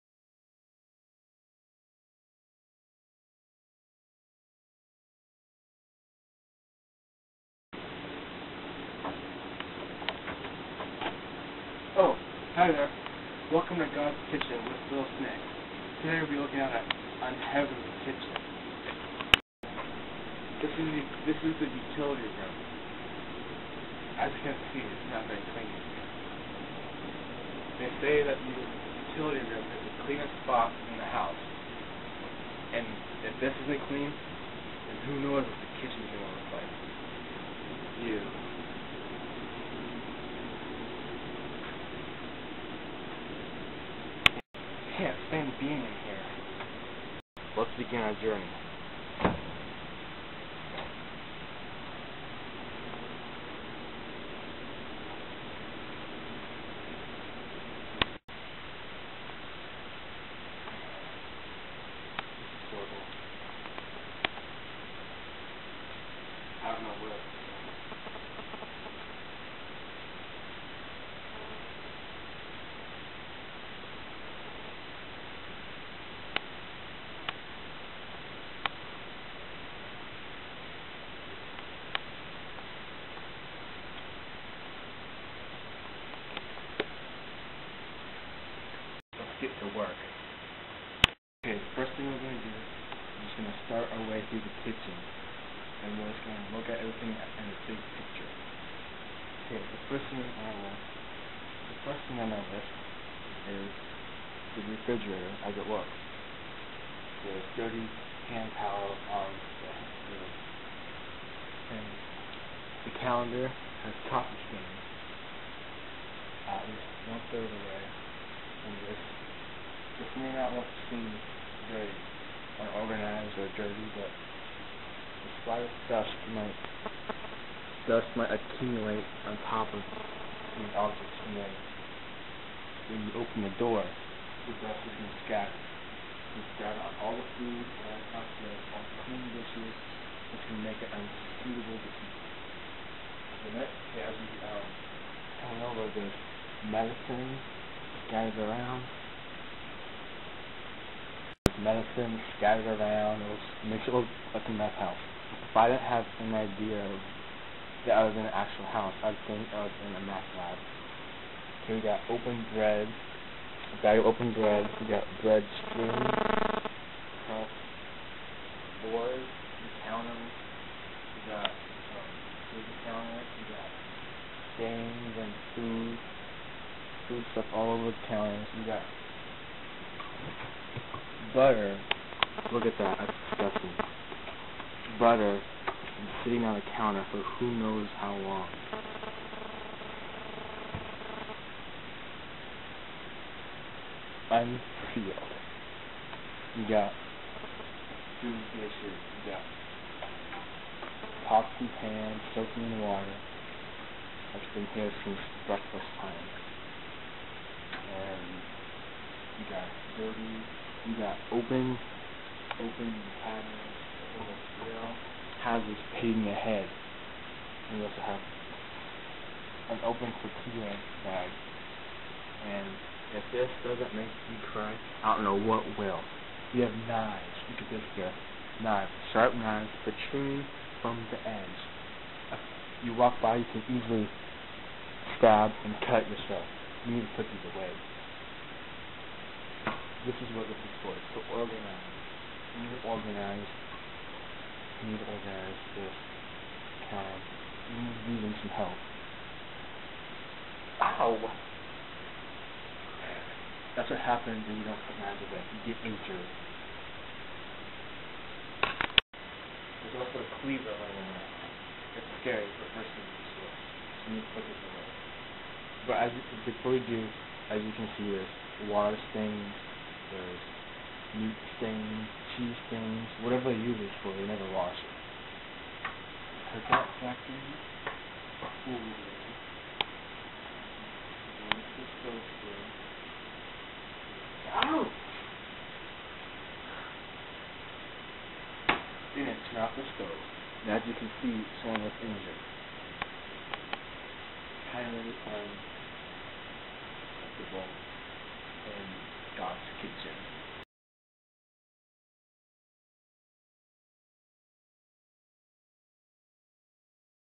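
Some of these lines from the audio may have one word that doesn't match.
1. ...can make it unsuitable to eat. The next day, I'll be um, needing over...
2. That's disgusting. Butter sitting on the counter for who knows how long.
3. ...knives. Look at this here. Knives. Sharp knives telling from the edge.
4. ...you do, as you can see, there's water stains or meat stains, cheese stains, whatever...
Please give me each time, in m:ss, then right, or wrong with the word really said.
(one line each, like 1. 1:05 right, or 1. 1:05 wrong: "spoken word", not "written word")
1. 2:20 wrong: "telling", not "needing"
2. 3:02 right
3. 3:46 wrong: "protruding", not "telling"
4. 4:26 right.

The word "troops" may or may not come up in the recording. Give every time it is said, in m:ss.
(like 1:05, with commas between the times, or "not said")
not said.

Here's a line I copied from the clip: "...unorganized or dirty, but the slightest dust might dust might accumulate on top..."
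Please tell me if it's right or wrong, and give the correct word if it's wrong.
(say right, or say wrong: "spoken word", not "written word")
right.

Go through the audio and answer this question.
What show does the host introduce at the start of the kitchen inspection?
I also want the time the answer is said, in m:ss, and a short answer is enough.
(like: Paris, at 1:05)
God's Kitchen, at 0:13.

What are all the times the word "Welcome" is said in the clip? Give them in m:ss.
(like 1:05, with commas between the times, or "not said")
0:13.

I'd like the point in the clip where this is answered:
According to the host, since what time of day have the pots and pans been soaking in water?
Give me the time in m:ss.
3:25.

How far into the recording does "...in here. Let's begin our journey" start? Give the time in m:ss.
0:45.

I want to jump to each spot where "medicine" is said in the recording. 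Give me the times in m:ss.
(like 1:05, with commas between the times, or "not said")
2:26, 2:31.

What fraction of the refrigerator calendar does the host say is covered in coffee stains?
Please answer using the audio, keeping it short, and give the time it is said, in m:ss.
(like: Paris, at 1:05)
one third, at 1:57.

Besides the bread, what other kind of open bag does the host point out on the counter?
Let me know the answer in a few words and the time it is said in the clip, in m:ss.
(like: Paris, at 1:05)
tortilla bag, at 3:40.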